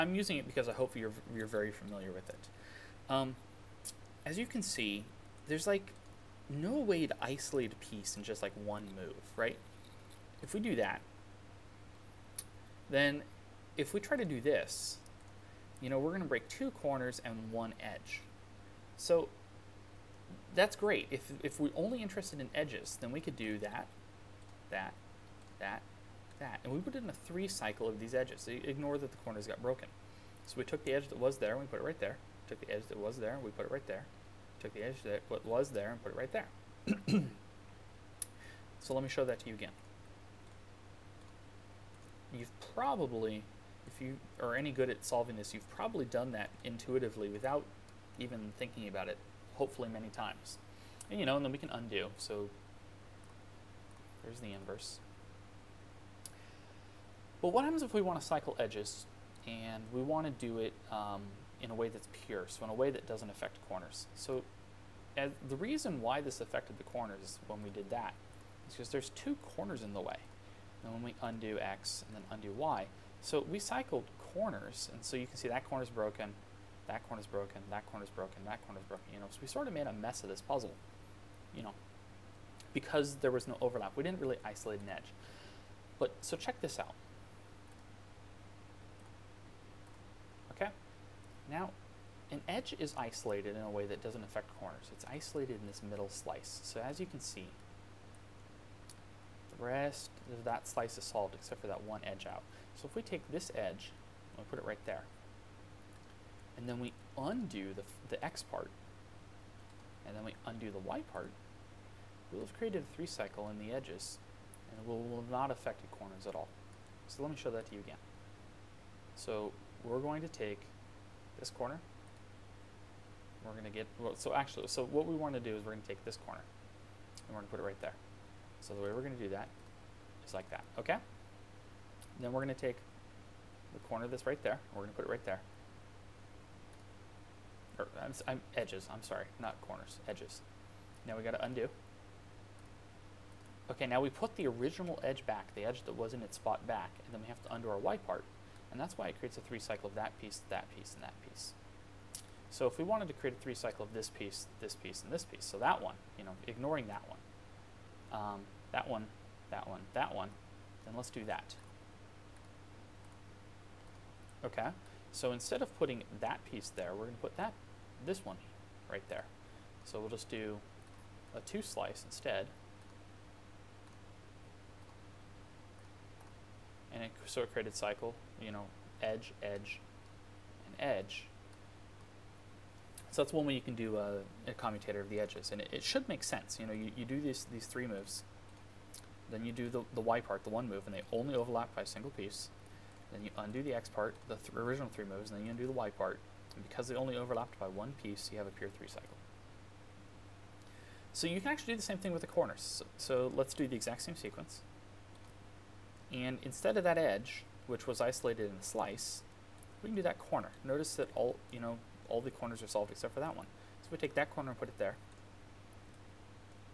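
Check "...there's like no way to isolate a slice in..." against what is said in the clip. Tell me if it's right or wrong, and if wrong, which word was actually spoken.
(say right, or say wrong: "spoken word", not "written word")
wrong: "piece", not "slice".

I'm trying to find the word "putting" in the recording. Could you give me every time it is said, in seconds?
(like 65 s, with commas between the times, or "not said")
165 s.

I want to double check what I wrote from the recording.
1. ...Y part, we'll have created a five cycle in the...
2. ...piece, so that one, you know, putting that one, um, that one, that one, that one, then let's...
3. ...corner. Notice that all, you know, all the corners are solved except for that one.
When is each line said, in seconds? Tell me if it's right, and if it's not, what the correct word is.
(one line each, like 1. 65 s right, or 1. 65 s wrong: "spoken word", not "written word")
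1. 110 s wrong: "three", not "five"
2. 155 s wrong: "ignoring", not "putting"
3. 210 s right.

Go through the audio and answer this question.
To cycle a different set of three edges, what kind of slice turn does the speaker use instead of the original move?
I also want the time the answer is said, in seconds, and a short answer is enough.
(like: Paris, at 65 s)
two slice, at 171 s.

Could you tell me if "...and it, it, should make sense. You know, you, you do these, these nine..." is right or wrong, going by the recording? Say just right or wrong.
wrong.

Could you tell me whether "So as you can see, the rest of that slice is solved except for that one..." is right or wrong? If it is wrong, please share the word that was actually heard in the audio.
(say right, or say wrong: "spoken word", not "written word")
right.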